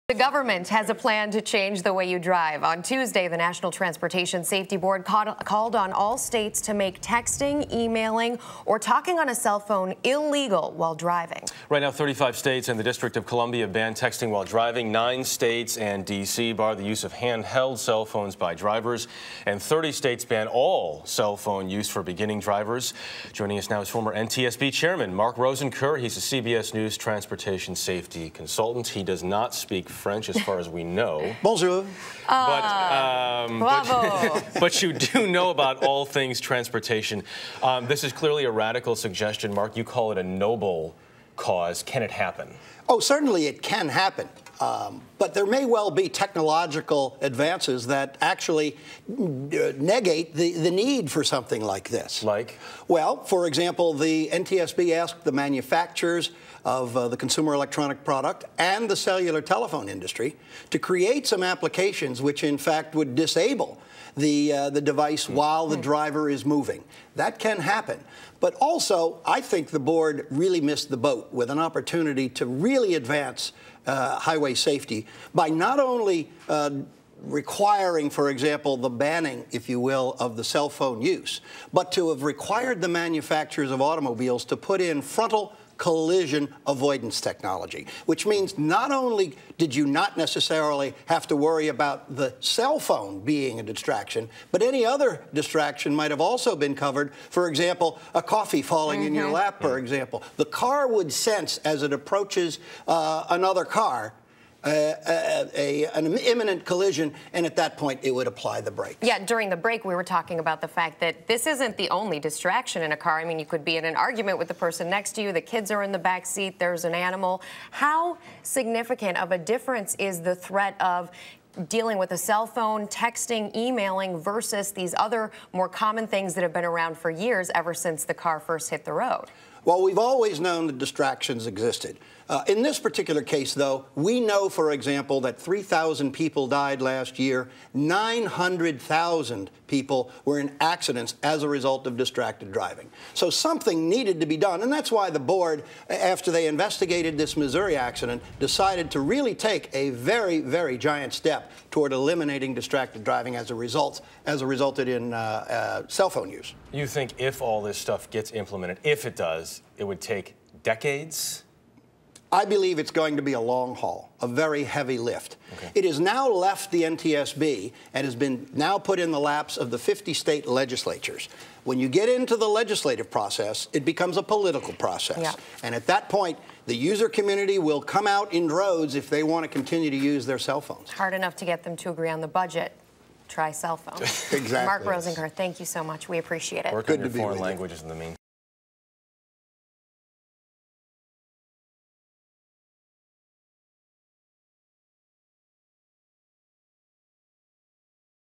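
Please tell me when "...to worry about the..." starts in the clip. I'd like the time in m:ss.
1:31.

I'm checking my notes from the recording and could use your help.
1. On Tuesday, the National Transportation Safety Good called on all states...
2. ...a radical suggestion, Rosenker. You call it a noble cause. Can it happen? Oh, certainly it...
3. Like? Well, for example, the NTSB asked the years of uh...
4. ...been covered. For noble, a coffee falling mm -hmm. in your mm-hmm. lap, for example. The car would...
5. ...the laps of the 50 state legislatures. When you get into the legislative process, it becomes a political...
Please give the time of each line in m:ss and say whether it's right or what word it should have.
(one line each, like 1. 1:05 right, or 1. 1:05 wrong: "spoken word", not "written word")
1. 0:02 wrong: "Board", not "Good"
2. 0:38 wrong: "Mark", not "Rosenker"
3. 0:52 wrong: "manufacturers", not "years"
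4. 1:36 wrong: "example", not "noble"
5. 2:49 right.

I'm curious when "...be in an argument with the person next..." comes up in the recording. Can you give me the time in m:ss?
1:53.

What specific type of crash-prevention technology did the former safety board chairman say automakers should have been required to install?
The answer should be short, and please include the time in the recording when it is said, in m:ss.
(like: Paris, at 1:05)
frontal collision avoidance technology, at 1:25.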